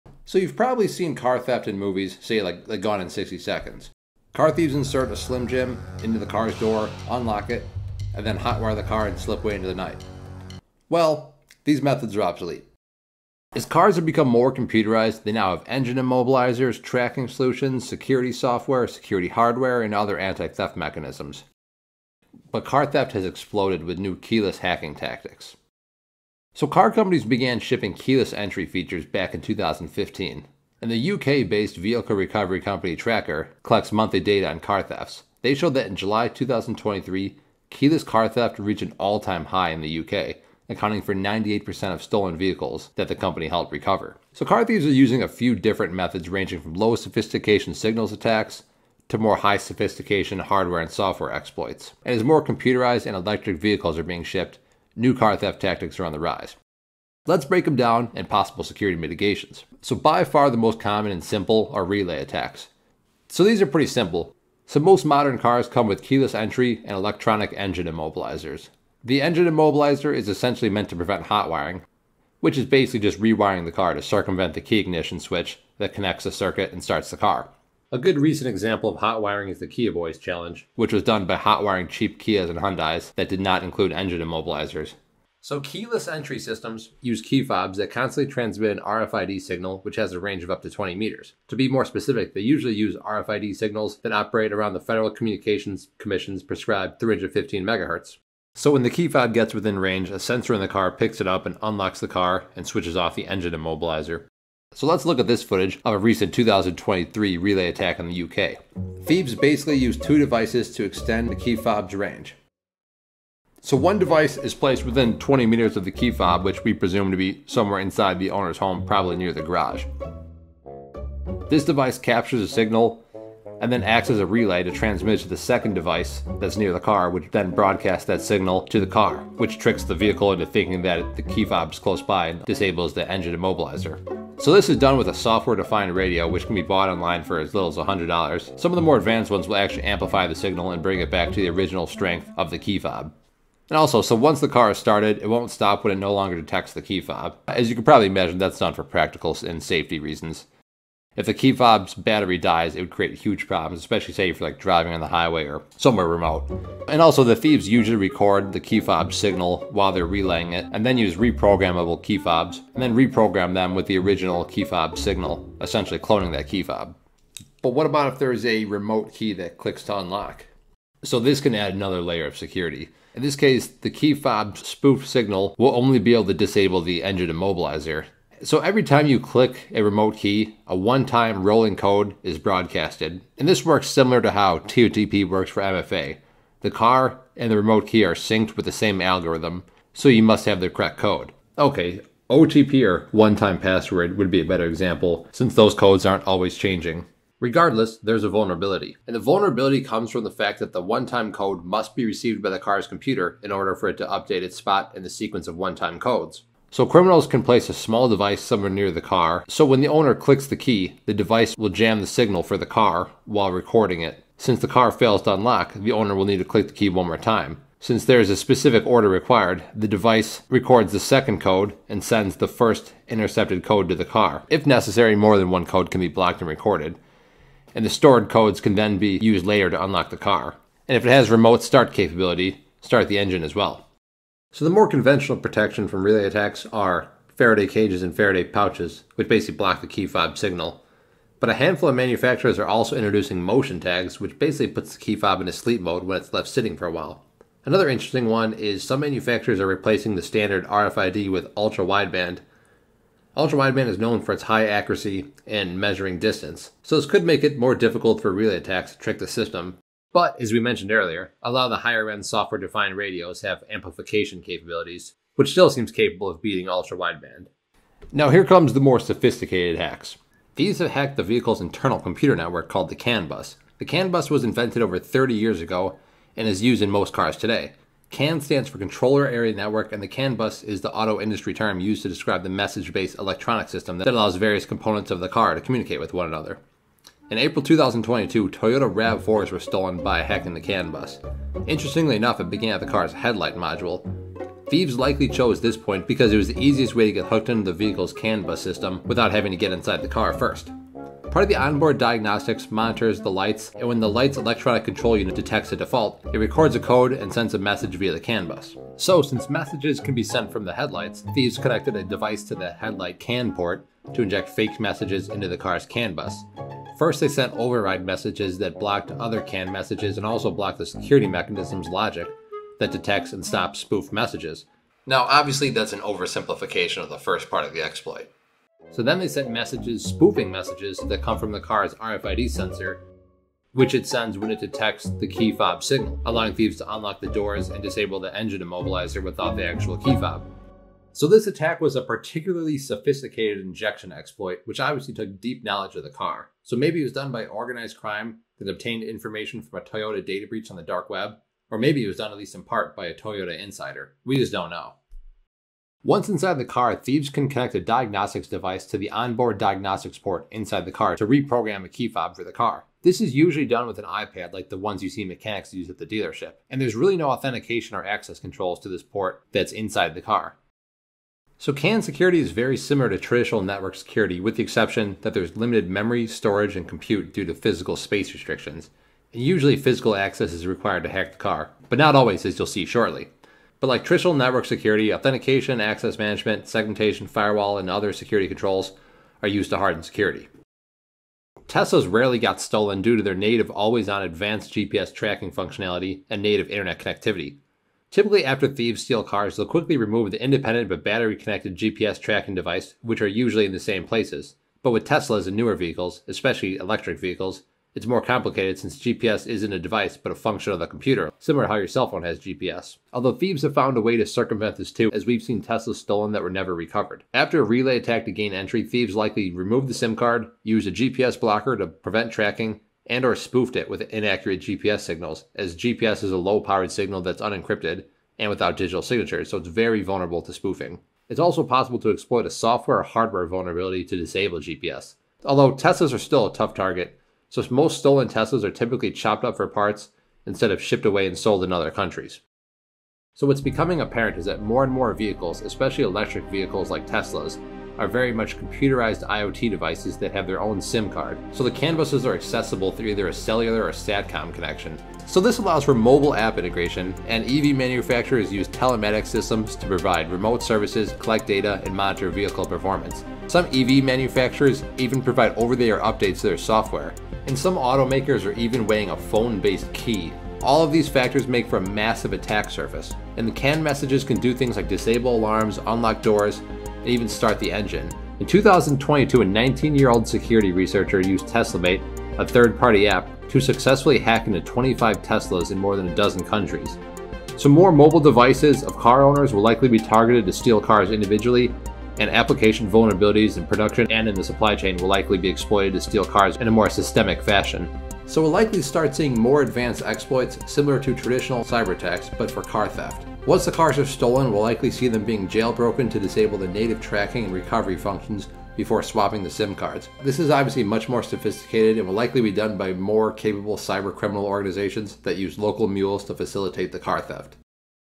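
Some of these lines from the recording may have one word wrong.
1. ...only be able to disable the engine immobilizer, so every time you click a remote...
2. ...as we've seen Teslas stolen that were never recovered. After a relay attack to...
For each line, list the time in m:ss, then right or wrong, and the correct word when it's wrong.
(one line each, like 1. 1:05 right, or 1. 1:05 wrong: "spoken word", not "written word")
1. 2:55 right
2. 6:55 right.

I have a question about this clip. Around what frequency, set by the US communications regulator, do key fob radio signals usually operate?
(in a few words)
315 megahertz.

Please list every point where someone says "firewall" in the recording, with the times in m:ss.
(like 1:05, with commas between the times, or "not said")
6:27.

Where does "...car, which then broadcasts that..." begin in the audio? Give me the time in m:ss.
2:06.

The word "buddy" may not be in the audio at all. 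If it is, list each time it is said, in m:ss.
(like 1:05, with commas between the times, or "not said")
not said.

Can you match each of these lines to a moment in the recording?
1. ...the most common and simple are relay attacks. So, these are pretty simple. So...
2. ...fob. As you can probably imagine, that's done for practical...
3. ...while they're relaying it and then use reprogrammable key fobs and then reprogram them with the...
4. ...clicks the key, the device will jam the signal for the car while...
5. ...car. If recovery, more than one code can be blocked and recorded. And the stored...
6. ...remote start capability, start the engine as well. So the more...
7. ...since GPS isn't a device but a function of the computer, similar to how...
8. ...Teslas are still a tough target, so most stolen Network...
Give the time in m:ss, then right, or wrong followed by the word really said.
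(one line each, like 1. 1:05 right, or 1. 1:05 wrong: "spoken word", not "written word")
1. 1:00 right
2. 2:27 right
3. 2:39 right
4. 3:30 right
5. 3:44 wrong: "necessary", not "recovery"
6. 3:51 right
7. 6:48 right
8. 7:15 wrong: "Teslas", not "Network".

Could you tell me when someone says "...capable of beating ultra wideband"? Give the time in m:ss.
4:25.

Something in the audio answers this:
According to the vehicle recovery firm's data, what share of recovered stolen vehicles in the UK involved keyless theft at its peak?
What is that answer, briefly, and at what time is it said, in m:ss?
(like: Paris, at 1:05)
98%, at 0:41.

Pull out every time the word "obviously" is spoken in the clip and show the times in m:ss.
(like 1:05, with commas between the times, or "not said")
5:25, 5:44, 8:30.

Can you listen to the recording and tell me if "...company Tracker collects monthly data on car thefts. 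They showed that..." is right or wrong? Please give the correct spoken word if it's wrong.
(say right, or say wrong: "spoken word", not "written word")
right.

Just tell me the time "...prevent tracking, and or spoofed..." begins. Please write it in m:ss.
7:01.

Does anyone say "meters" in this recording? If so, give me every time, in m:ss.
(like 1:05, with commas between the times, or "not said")
1:30, 1:55.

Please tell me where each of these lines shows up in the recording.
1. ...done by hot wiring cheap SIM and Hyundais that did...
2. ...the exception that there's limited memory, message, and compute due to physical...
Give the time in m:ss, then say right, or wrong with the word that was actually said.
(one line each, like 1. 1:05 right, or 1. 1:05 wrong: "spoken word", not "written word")
1. 1:21 wrong: "Kias", not "SIM"
2. 6:14 wrong: "storage", not "message".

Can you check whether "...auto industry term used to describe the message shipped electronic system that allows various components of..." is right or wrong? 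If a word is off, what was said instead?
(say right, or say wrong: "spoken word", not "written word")
wrong: "based", not "shipped".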